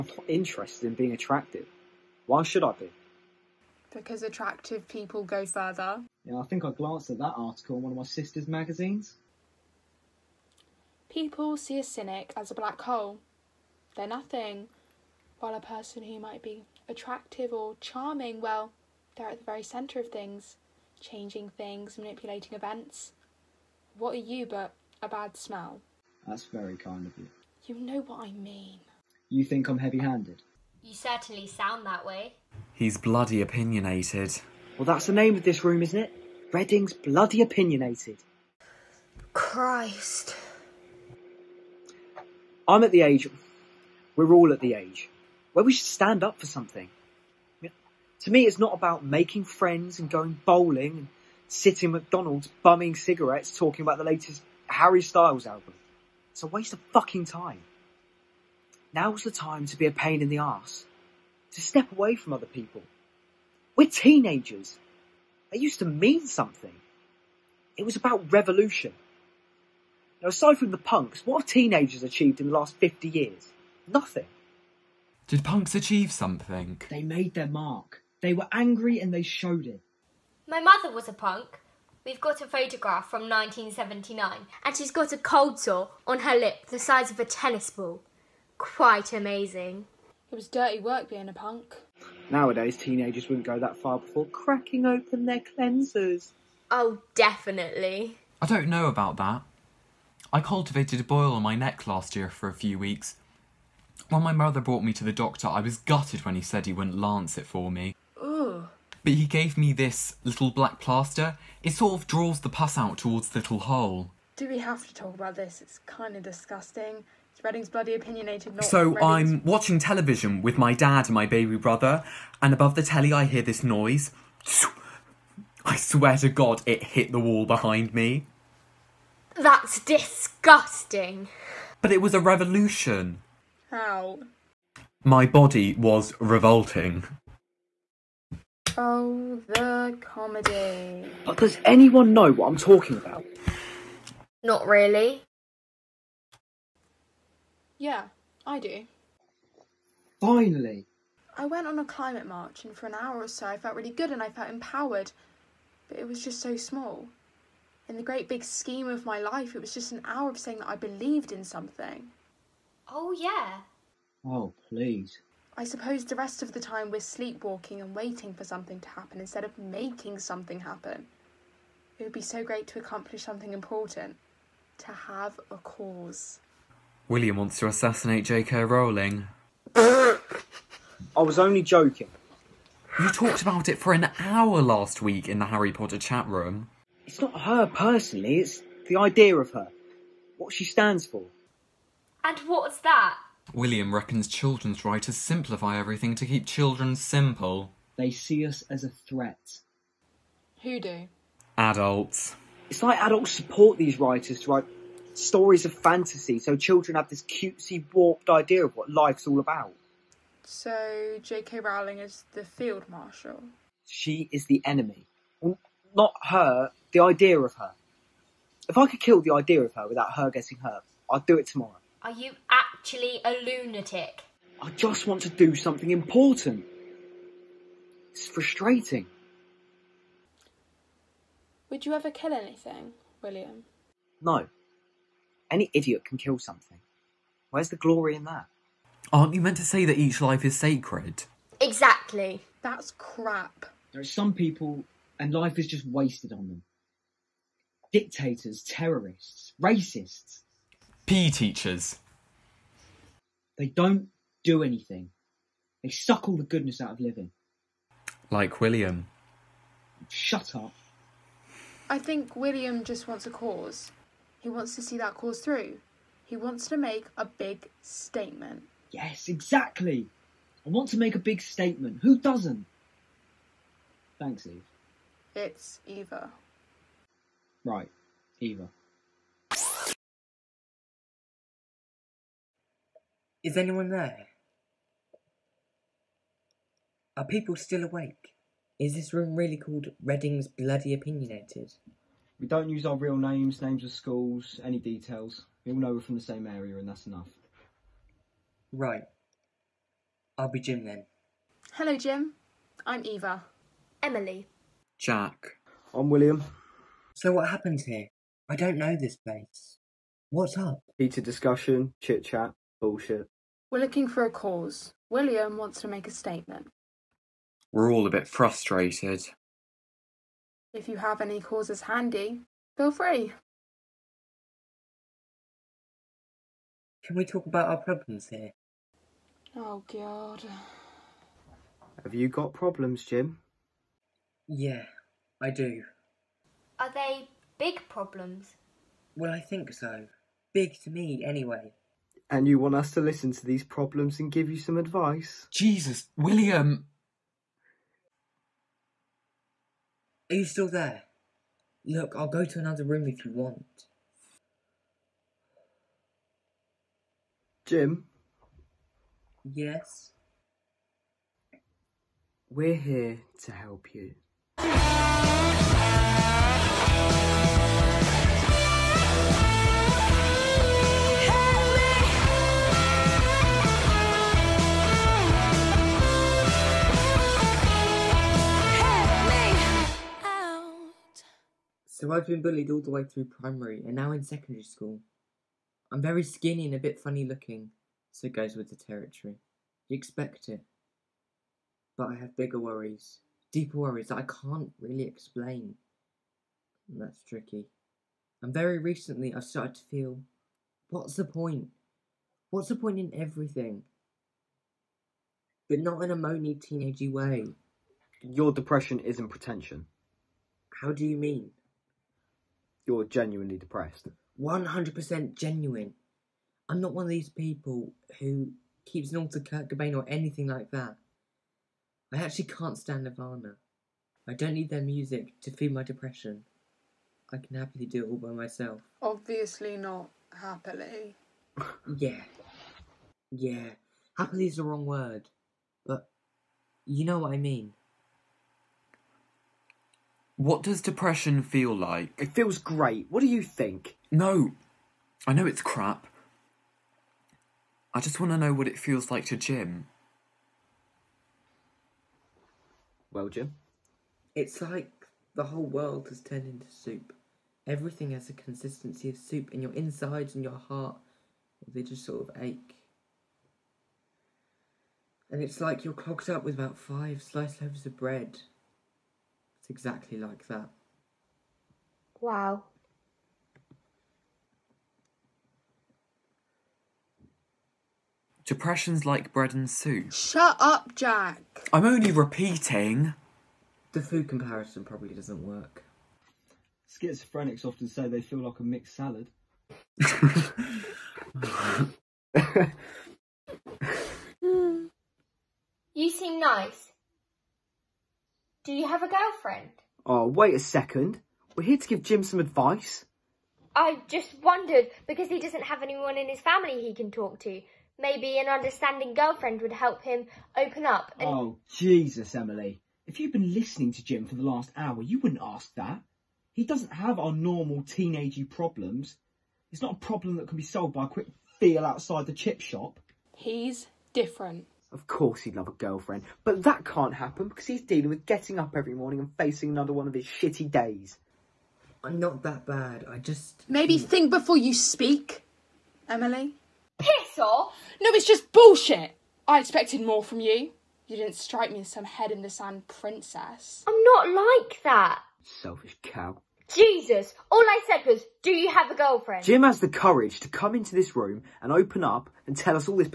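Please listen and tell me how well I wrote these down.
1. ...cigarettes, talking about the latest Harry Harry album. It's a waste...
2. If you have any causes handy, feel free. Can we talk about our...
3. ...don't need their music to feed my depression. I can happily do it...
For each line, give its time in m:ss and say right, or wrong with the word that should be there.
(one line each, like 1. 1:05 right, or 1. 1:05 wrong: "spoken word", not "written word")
1. 0:52 wrong: "Styles", not "Harry"
2. 5:20 right
3. 7:04 right.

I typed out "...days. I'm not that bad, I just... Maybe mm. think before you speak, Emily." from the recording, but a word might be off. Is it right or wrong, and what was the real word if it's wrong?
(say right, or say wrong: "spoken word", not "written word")
right.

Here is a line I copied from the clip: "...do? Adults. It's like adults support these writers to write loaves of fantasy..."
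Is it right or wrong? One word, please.
wrong.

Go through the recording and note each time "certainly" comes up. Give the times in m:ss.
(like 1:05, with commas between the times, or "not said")
0:30.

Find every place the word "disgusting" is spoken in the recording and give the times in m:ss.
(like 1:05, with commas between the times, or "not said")
1:56, 2:09.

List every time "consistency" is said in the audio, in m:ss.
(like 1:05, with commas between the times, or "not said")
7:38.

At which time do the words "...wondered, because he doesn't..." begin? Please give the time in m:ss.
8:24.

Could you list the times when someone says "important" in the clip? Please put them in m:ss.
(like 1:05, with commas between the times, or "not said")
2:53, 3:45.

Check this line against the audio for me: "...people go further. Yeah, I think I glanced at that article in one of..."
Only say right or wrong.
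right.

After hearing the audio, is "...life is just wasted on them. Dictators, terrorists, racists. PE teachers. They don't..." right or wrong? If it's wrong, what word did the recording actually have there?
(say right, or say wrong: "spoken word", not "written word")
right.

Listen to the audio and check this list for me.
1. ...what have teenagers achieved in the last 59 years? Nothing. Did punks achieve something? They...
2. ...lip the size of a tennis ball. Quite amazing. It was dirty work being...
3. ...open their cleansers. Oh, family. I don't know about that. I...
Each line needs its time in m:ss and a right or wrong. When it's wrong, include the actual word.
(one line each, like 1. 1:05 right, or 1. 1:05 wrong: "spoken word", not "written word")
1. 1:11 wrong: "50", not "59"
2. 1:26 right
3. 1:34 wrong: "definitely", not "family".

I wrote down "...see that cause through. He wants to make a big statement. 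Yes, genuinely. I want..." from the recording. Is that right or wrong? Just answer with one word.
wrong.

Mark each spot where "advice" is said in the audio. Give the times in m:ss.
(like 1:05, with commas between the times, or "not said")
5:44, 8:22.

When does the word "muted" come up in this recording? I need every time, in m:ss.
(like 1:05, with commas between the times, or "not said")
not said.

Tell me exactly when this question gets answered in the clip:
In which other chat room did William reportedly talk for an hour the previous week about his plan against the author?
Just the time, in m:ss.
3:05.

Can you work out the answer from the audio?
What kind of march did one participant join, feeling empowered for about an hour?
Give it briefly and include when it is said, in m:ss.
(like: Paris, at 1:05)
Climate march, at 2:31.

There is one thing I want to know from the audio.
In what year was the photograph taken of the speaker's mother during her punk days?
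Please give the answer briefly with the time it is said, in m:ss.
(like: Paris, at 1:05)
1979, at 1:23.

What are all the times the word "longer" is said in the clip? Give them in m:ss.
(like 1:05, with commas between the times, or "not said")
not said.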